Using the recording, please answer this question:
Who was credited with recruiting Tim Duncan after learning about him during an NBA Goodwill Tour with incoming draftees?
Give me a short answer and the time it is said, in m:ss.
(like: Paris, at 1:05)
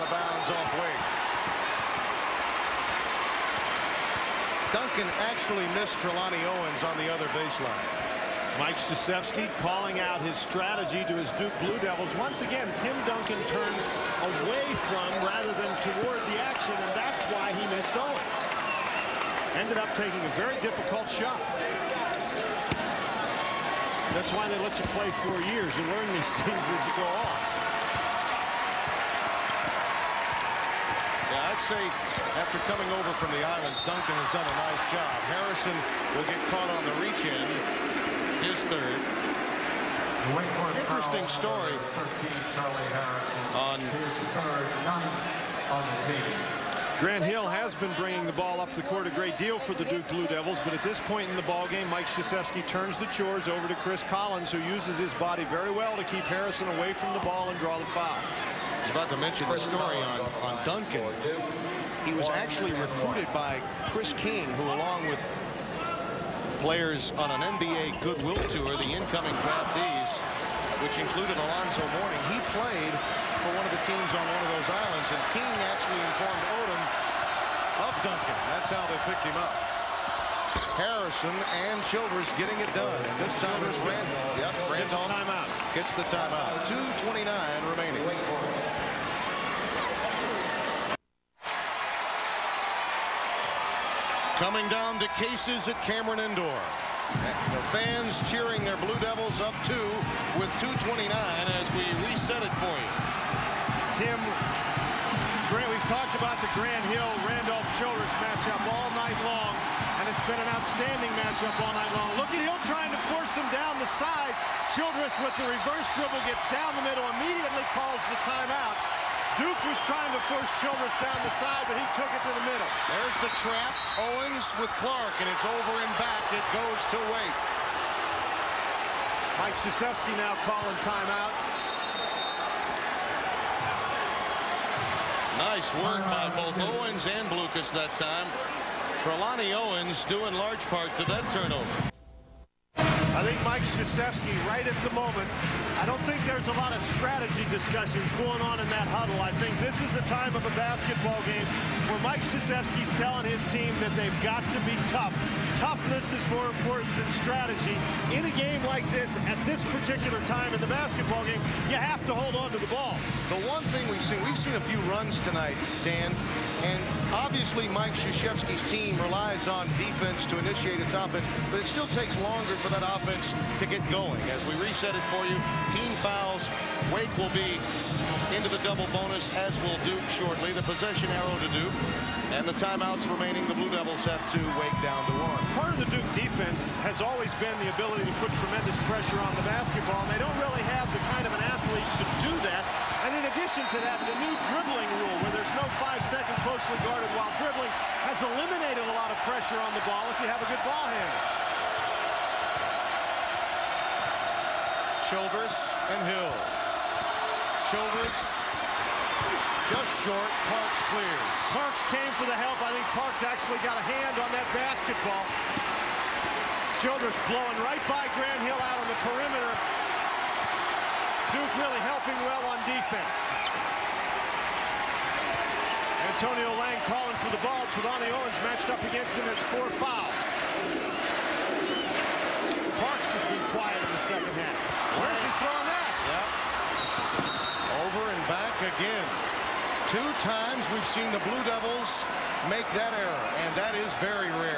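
Chris King, at 1:03.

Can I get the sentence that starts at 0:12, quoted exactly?
Once again, Tim Duncan turns away from rather than toward the action, and that's why he missed Owens.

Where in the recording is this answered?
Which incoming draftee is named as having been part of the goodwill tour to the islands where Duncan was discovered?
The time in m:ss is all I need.
1:11.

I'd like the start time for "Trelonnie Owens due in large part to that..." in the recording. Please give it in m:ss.
2:19.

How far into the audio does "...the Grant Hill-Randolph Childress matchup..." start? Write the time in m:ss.
1:46.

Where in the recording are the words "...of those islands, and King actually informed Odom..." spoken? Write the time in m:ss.
1:14.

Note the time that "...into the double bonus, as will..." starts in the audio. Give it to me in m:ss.
2:58.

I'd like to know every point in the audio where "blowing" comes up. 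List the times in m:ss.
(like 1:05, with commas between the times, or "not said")
3:37.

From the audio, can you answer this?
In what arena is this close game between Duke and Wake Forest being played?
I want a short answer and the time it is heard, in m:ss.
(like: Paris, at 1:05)
Cameron Indoor, at 1:35.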